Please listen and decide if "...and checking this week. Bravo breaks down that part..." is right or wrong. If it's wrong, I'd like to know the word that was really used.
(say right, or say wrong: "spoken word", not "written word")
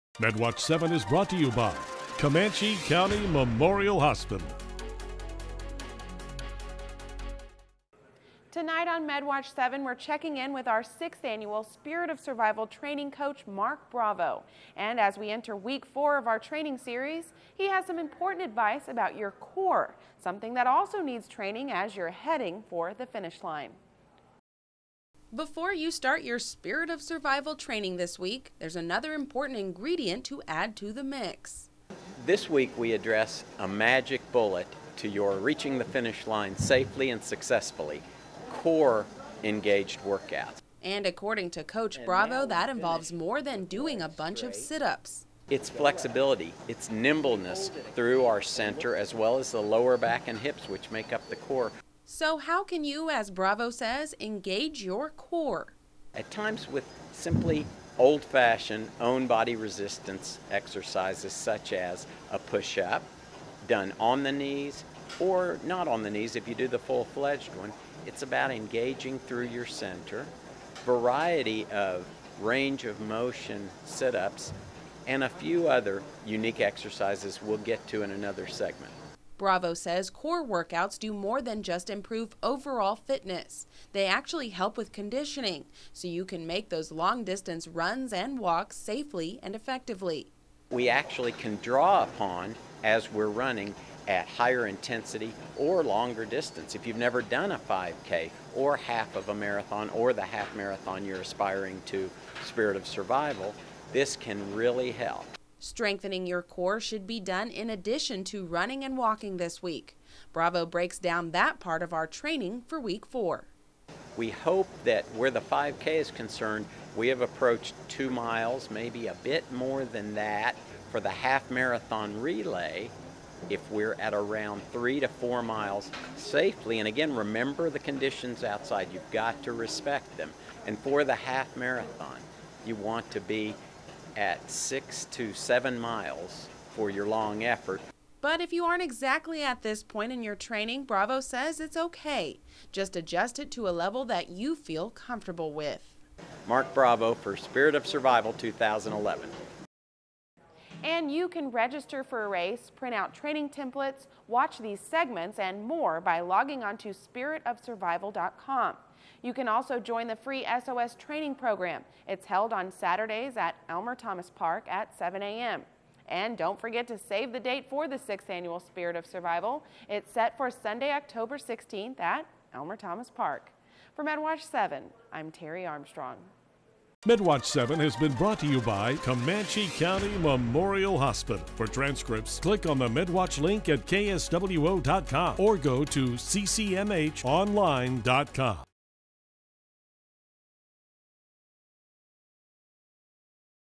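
wrong: "walking", not "checking".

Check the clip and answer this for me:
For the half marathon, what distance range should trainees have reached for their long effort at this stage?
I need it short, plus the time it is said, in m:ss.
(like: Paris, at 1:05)
6 to 7 miles, at 2:14.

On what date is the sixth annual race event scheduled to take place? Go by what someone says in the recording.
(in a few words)
October 16th.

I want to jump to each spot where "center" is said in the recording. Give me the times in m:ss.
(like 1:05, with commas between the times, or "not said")
0:48, 1:09.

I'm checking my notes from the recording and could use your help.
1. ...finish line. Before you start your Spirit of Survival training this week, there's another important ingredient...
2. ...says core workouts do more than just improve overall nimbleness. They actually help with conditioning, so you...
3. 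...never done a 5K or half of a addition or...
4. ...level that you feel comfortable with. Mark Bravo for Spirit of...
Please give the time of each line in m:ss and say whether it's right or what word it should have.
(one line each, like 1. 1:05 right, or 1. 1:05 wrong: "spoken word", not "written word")
1. 0:23 right
2. 1:19 wrong: "fitness", not "nimbleness"
3. 1:36 wrong: "marathon", not "addition"
4. 2:23 right.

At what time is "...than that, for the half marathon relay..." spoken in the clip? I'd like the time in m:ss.
1:59.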